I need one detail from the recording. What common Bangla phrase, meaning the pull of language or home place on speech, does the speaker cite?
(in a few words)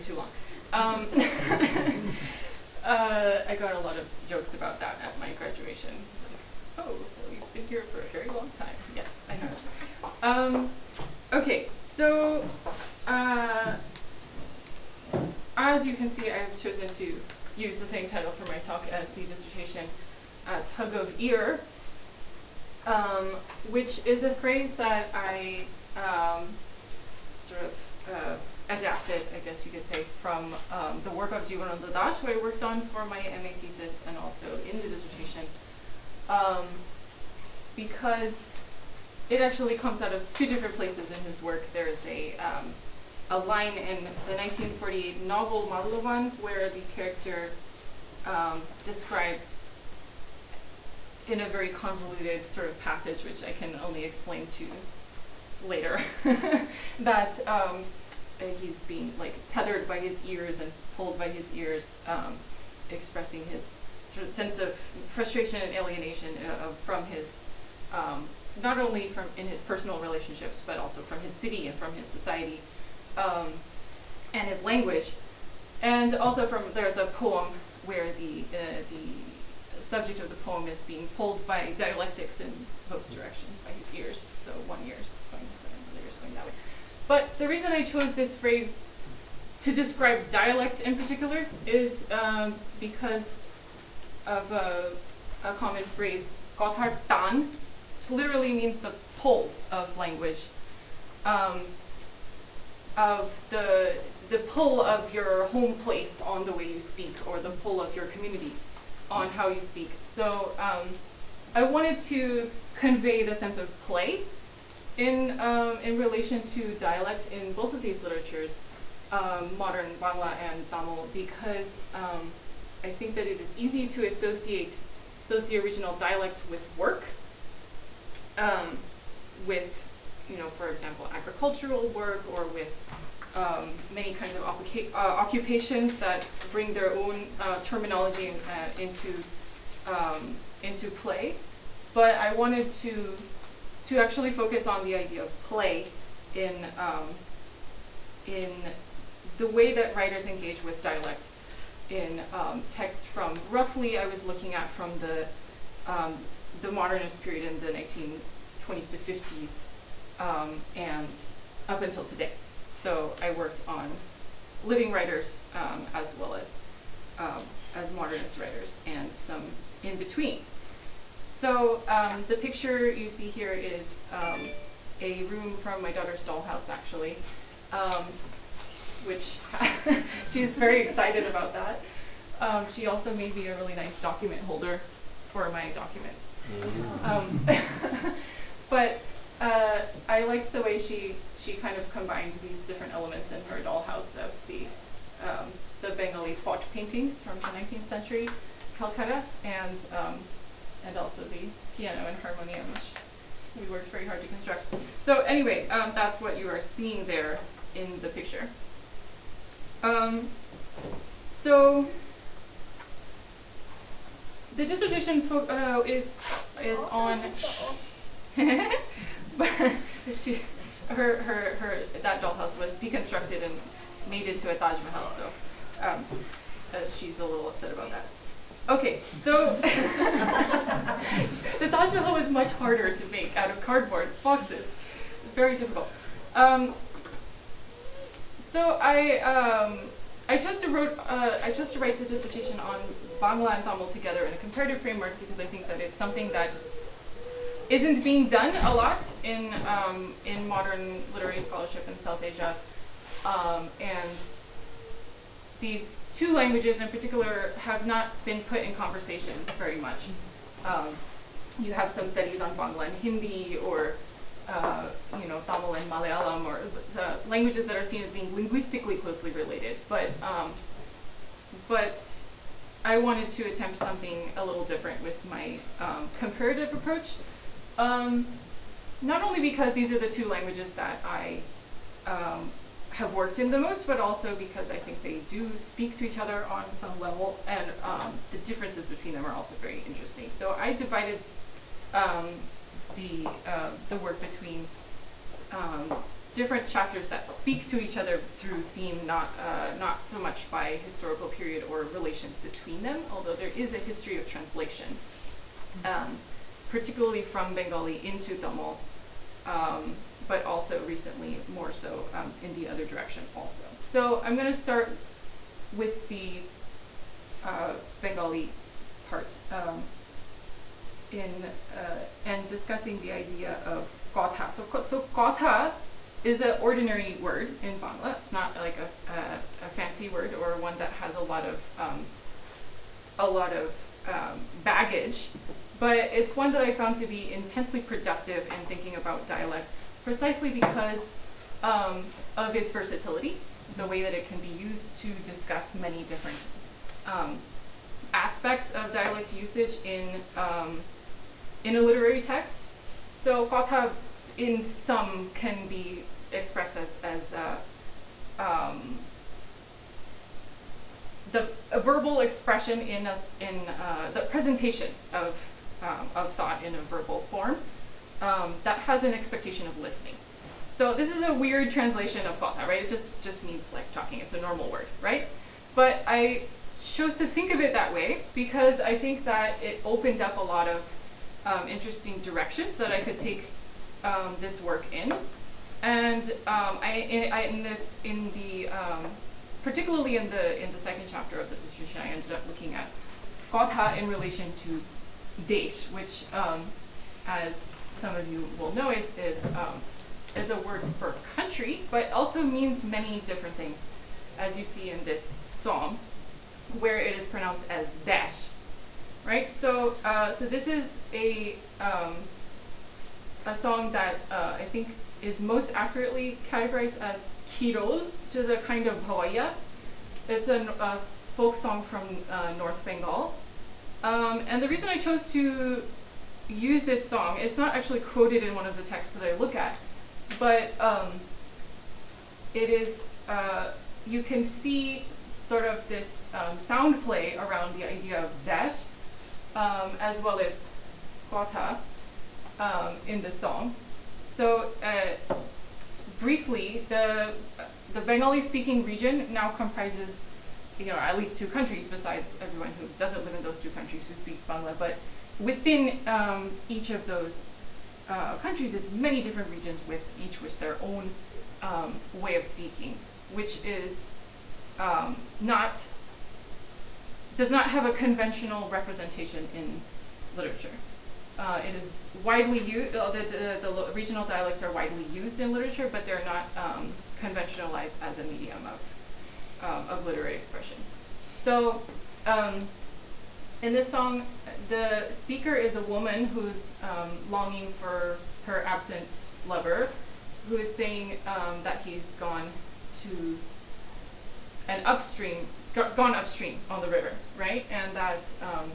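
kothar tan.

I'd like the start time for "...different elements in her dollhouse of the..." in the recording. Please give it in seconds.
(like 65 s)
192 s.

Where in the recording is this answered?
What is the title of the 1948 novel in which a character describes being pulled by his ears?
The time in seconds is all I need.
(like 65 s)
45 s.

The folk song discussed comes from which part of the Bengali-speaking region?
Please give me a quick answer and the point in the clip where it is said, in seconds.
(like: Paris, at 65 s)
North Bengal, at 422 s.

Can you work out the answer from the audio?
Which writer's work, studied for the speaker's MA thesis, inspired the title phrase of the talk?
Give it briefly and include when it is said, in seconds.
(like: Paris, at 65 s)
Jibanananda Das, at 31 s.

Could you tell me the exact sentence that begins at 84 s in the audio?
So one ear's going this way, and ear's going that way.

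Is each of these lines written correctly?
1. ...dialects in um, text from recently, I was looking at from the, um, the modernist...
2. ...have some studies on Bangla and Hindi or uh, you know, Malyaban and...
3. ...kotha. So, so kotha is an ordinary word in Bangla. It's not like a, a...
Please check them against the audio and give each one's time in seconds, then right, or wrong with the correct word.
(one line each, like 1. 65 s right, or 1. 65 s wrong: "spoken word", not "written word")
1. 150 s wrong: "roughly", not "recently"
2. 261 s wrong: "Tamil", not "Malyaban"
3. 324 s right.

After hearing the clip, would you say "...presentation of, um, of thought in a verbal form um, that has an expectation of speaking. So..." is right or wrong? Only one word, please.
wrong.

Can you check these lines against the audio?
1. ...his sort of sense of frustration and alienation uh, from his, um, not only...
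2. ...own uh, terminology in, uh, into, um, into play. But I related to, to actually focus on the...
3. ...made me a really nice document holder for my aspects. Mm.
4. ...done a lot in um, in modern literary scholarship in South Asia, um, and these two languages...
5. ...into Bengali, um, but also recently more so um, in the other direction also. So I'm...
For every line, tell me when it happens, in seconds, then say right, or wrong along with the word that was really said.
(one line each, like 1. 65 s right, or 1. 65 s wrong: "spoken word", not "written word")
1. 63 s right
2. 136 s wrong: "wanted", not "related"
3. 183 s wrong: "documents", not "aspects"
4. 248 s right
5. 308 s wrong: "Tamil", not "Bengali".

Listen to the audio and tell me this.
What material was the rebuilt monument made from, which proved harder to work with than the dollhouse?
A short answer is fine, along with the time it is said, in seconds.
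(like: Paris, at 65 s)
cardboard boxes, at 233 s.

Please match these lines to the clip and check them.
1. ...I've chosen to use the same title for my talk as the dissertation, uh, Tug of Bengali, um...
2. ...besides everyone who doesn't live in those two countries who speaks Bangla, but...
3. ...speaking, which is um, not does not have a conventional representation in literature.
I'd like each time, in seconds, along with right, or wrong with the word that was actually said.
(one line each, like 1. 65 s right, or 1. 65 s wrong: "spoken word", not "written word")
1. 16 s wrong: "Ear", not "Bengali"
2. 451 s right
3. 462 s right.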